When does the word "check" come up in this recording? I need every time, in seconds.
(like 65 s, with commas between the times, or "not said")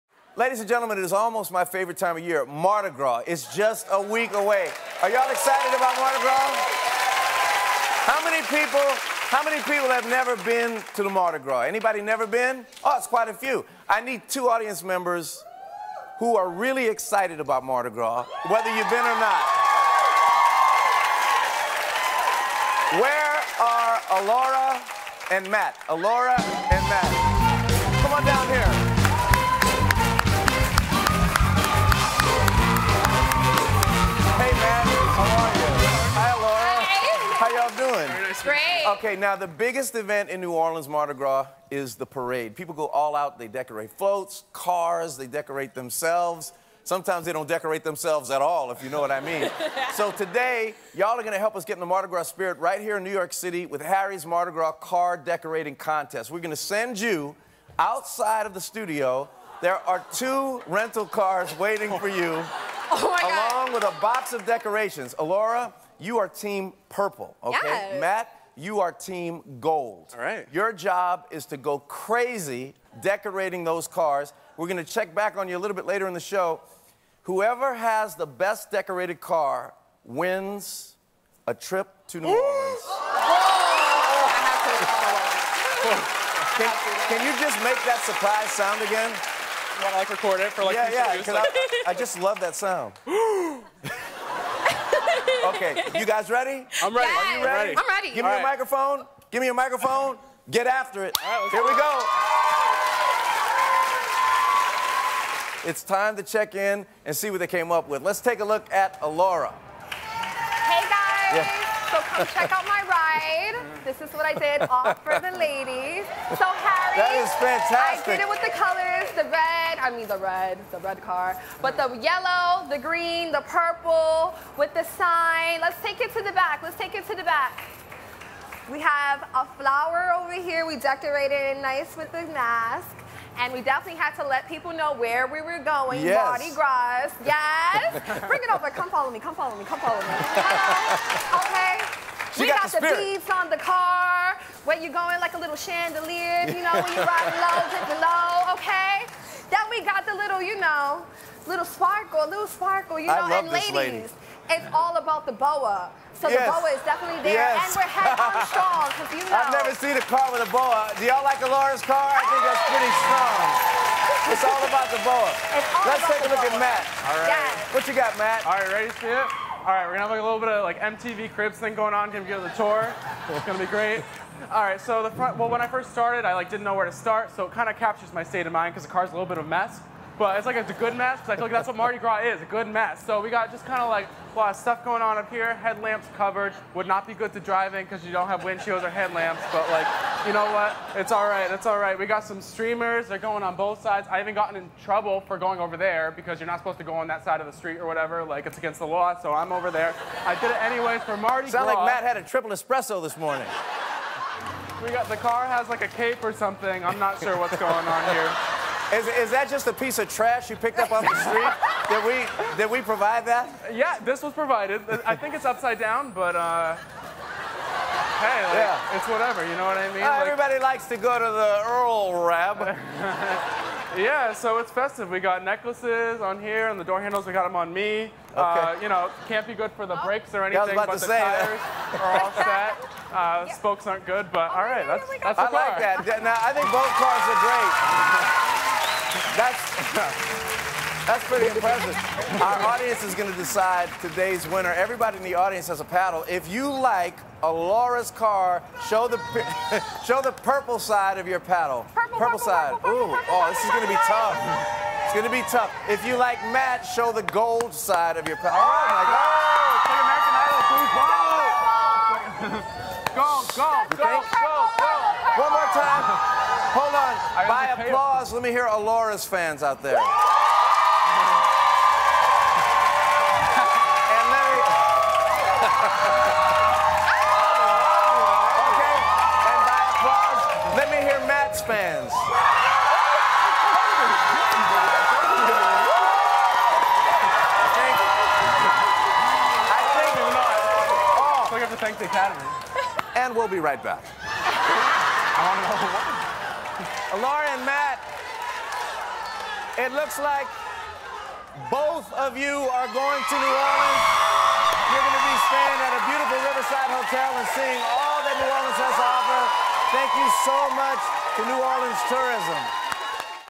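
74 s, 106 s, 112 s.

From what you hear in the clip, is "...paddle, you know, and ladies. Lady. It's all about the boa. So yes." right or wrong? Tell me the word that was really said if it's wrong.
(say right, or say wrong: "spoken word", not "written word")
wrong: "sparkle", not "paddle".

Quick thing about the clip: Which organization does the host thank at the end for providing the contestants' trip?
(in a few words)
New Orleans Tourism.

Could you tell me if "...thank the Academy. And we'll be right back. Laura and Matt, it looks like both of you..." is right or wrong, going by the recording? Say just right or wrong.
right.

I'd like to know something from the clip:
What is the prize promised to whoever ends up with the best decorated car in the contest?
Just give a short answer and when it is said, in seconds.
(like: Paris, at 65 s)
A trip to New Orleans, at 81 s.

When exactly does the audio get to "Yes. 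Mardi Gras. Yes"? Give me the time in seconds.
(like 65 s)
136 s.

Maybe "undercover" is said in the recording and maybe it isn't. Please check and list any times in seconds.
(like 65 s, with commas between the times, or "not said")
not said.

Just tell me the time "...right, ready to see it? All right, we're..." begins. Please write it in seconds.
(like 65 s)
168 s.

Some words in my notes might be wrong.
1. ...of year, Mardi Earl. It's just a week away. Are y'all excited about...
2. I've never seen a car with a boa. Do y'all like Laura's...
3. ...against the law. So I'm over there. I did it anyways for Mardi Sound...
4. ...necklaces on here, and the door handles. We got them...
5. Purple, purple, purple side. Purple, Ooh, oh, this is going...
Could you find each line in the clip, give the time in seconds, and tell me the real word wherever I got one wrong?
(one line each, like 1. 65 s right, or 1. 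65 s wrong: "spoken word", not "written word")
1. 2 s wrong: "Gras", not "Earl"
2. 159 s right
3. 198 s right
4. 225 s right
5. 251 s right.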